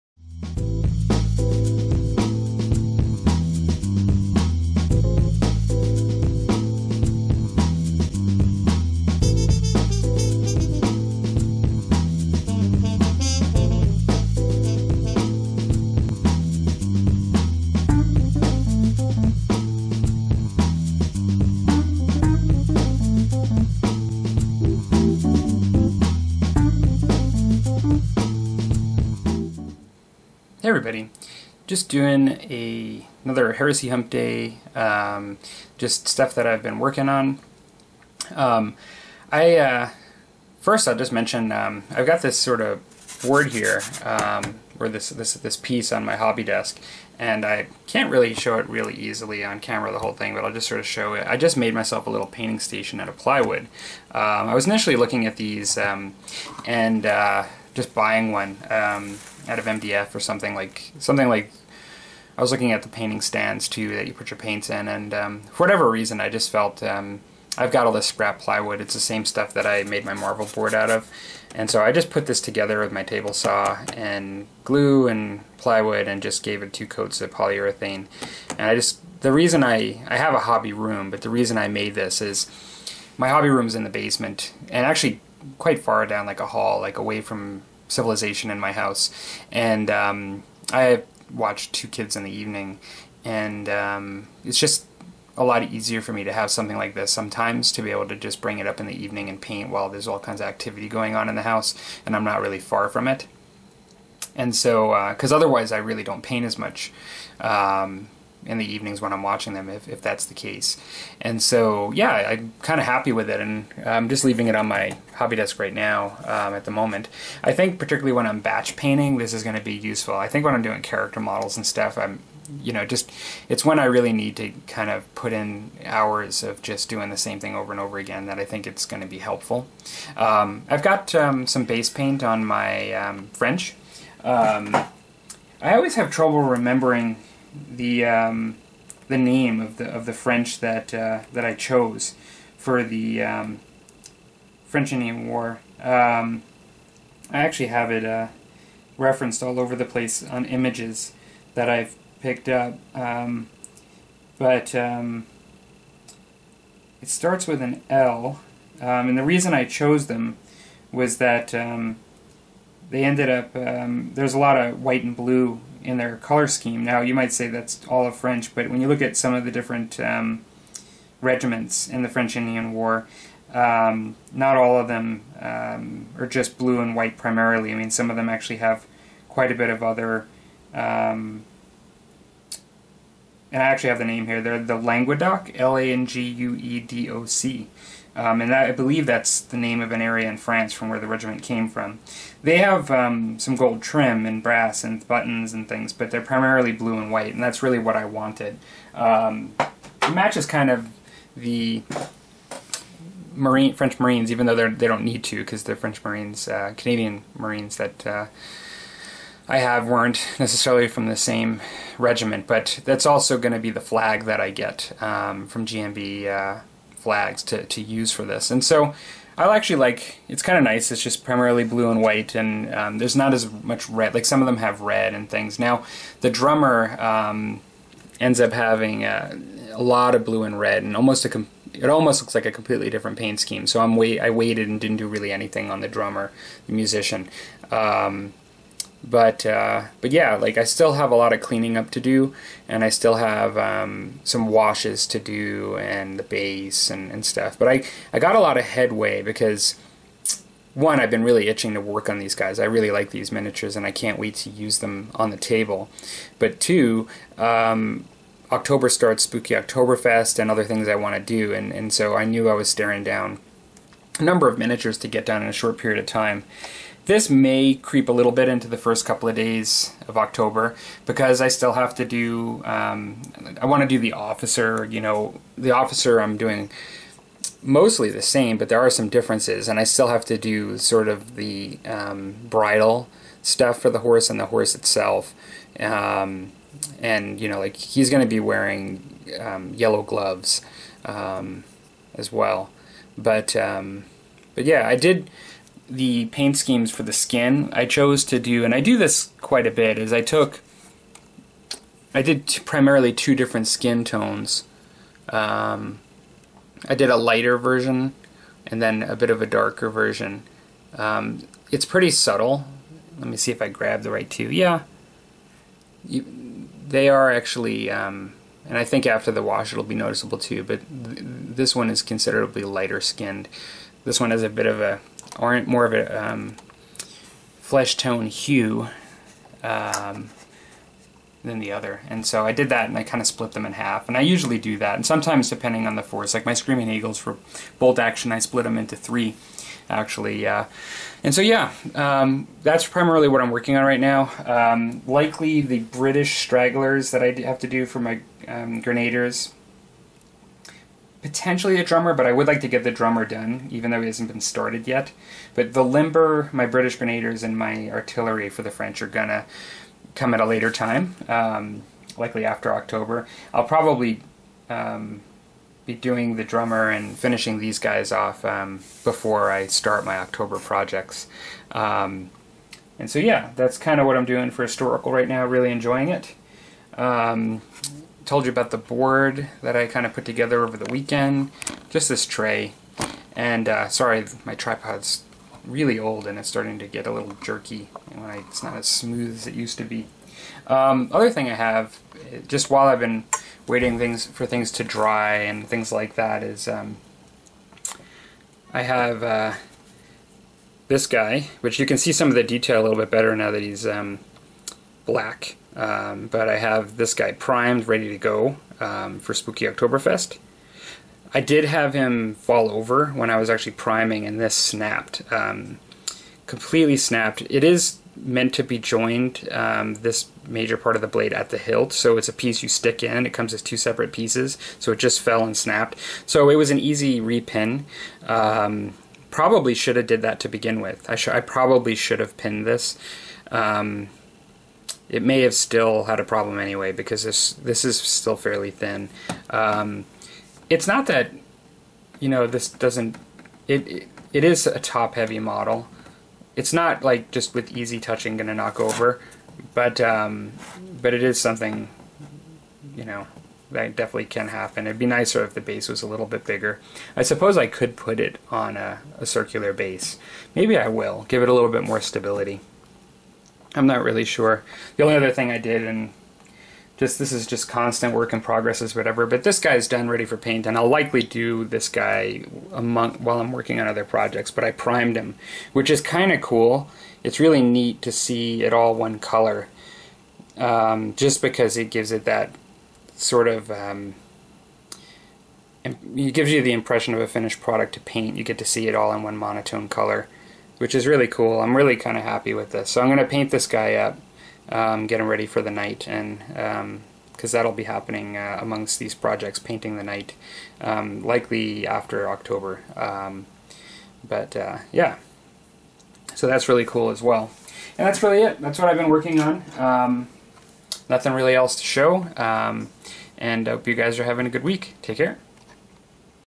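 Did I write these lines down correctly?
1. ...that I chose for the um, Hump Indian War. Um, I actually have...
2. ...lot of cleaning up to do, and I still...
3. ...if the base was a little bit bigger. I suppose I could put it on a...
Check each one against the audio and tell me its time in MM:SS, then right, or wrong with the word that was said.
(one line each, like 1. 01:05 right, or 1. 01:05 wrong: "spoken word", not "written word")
1. 02:21 wrong: "French", not "Hump"
2. 04:01 right
3. 07:35 right.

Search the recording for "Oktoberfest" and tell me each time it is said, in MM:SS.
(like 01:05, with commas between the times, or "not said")
04:19, 06:49.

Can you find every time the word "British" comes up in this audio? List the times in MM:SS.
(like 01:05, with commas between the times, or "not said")
05:45, 05:56.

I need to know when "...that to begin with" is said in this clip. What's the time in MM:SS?
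07:10.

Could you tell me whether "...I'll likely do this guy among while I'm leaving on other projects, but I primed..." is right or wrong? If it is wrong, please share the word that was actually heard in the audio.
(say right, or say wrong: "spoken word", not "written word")
wrong: "working", not "leaving".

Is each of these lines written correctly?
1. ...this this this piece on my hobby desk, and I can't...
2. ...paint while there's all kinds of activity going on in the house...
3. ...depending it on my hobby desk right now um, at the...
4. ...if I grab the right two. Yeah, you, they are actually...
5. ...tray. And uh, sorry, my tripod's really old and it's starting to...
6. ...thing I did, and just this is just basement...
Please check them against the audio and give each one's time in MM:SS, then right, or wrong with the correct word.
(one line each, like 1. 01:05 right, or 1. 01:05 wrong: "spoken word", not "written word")
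1. 00:44 right
2. 01:39 right
3. 01:54 wrong: "leaving", not "depending"
4. 05:13 right
5. 06:22 right
6. 07:45 wrong: "constant", not "basement".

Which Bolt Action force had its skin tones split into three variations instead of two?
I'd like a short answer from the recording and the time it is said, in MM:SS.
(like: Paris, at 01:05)
Screaming Eagles, at 05:36.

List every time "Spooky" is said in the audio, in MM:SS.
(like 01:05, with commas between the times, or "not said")
04:19, 06:49.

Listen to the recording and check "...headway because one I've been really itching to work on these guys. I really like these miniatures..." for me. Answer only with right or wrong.
right.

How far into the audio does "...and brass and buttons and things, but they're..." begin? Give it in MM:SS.
03:14.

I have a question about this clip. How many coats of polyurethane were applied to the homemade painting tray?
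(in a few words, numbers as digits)
2.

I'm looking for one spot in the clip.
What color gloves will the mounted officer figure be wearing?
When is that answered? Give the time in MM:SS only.
04:49.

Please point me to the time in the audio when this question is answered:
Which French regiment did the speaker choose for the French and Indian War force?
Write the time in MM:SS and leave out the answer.
03:04.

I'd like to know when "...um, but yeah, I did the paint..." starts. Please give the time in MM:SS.
04:53.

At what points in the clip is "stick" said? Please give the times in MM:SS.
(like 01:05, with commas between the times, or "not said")
07:02.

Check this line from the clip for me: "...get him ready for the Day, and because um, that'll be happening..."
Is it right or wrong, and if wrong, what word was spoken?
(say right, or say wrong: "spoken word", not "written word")
wrong: "Knight", not "Day".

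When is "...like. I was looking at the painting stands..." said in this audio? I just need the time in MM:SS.
01:01.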